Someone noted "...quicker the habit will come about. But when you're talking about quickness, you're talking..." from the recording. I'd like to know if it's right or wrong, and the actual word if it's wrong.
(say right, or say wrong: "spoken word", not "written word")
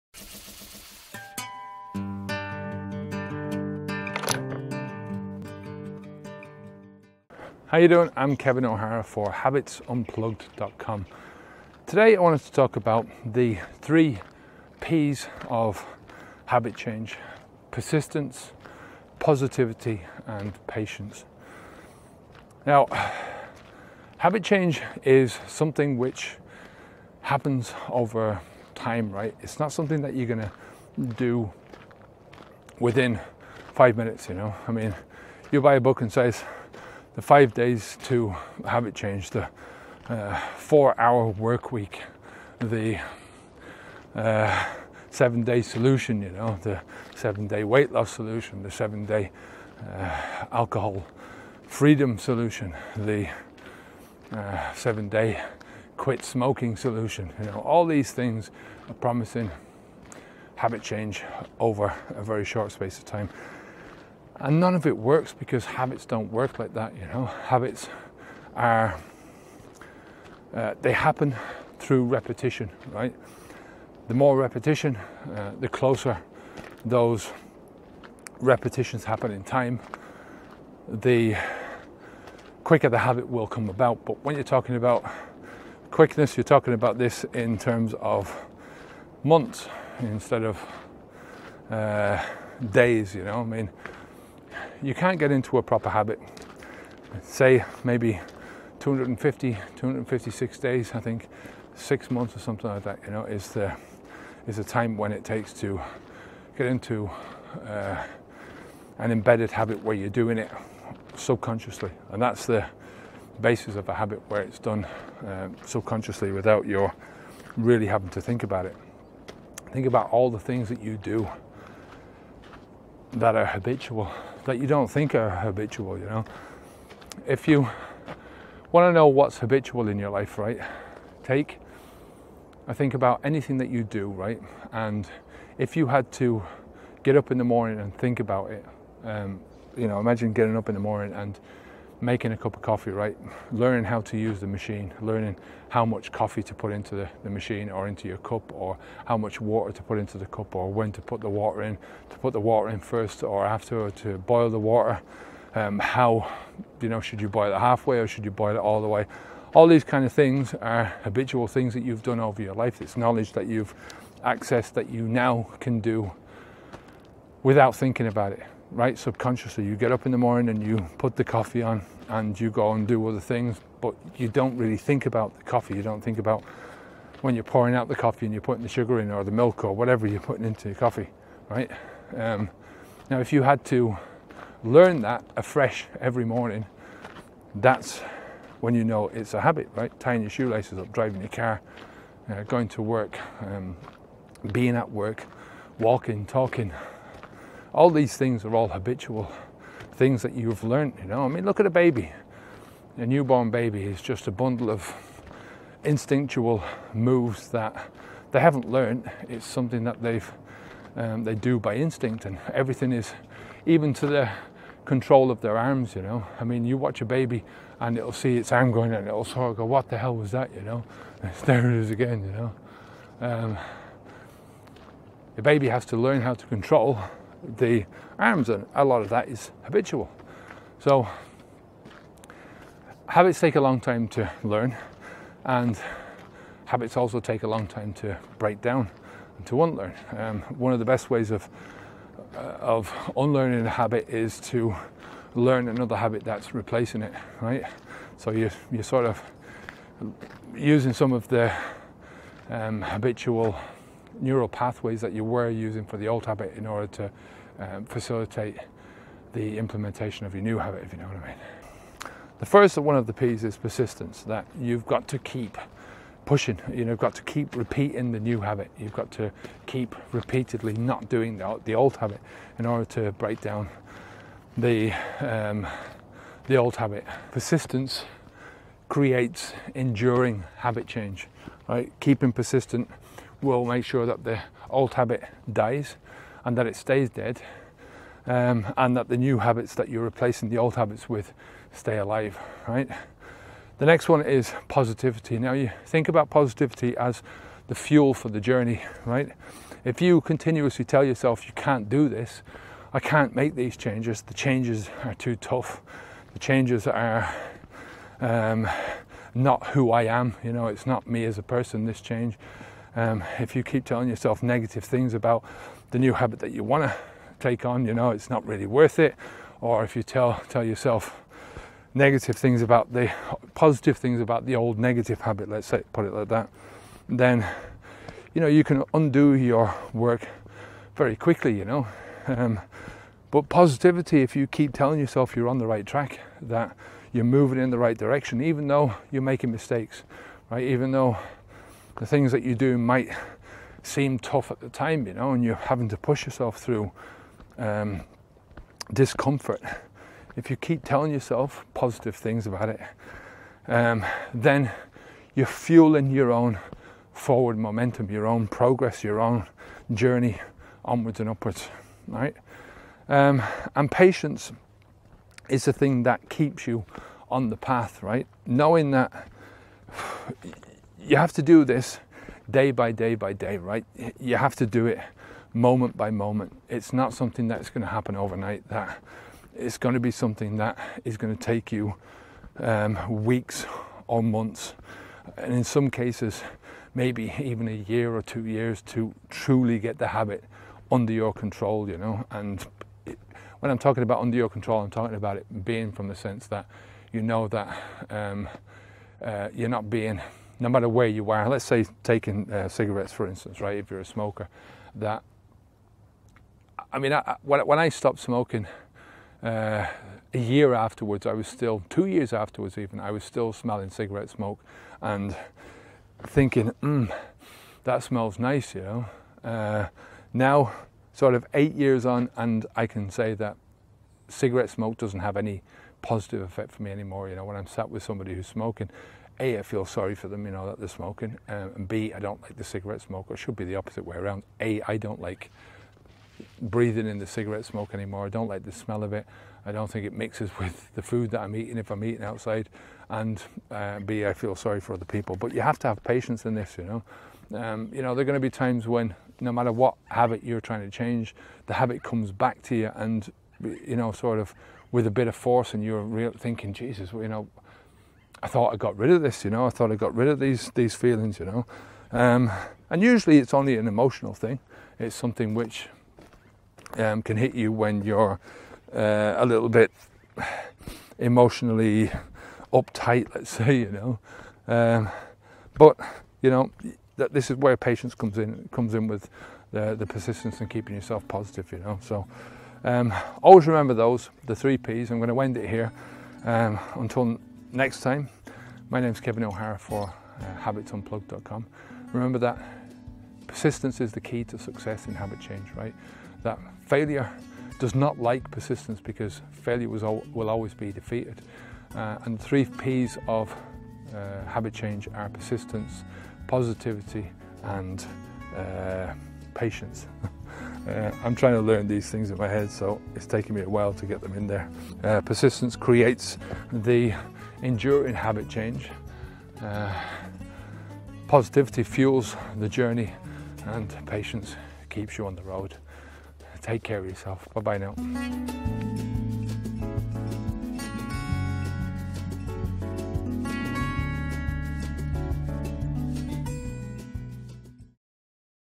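right.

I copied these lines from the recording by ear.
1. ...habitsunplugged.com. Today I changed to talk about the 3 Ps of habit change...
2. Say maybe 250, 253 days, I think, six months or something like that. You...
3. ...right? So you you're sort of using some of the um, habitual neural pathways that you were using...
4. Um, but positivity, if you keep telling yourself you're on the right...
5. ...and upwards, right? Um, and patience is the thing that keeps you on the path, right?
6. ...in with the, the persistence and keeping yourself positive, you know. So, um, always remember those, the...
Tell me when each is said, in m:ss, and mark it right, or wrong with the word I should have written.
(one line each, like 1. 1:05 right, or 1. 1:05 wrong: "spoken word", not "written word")
1. 0:09 wrong: "wanted", not "changed"
2. 1:37 wrong: "256", not "253"
3. 4:07 right
4. 5:32 right
5. 6:01 right
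6. 7:58 right.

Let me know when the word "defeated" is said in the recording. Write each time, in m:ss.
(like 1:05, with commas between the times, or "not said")
8:20.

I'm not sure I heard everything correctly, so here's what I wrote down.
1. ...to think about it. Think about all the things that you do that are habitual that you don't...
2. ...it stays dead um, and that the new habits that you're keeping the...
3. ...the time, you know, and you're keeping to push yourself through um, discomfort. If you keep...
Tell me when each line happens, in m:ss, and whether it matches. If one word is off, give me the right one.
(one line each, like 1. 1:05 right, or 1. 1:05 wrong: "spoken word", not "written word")
1. 1:58 right
2. 4:46 wrong: "replacing", not "keeping"
3. 5:44 wrong: "having", not "keeping".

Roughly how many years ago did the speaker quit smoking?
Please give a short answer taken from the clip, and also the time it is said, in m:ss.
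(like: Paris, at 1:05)
8 years, at 7:01.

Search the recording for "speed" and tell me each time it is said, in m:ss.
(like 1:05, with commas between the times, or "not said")
not said.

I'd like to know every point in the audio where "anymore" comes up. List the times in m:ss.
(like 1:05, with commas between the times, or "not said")
7:06, 7:17.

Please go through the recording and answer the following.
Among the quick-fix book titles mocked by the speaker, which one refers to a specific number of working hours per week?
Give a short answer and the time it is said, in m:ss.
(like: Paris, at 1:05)
Four hour work week, at 0:40.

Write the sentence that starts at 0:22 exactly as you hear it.
Now, habit change is something which happens over time, right?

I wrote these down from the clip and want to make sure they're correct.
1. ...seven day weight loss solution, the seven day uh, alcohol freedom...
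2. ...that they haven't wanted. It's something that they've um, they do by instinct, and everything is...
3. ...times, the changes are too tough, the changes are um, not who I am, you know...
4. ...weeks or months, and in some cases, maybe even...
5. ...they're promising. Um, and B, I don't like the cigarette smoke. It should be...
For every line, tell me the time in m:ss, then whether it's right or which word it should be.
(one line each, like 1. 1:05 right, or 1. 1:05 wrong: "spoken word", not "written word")
1. 0:47 right
2. 3:27 wrong: "learned", not "wanted"
3. 5:03 wrong: "changes", not "times"
4. 6:23 right
5. 7:10 wrong: "smoking", not "promising".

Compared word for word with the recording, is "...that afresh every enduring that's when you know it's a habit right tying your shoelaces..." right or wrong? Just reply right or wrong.
wrong.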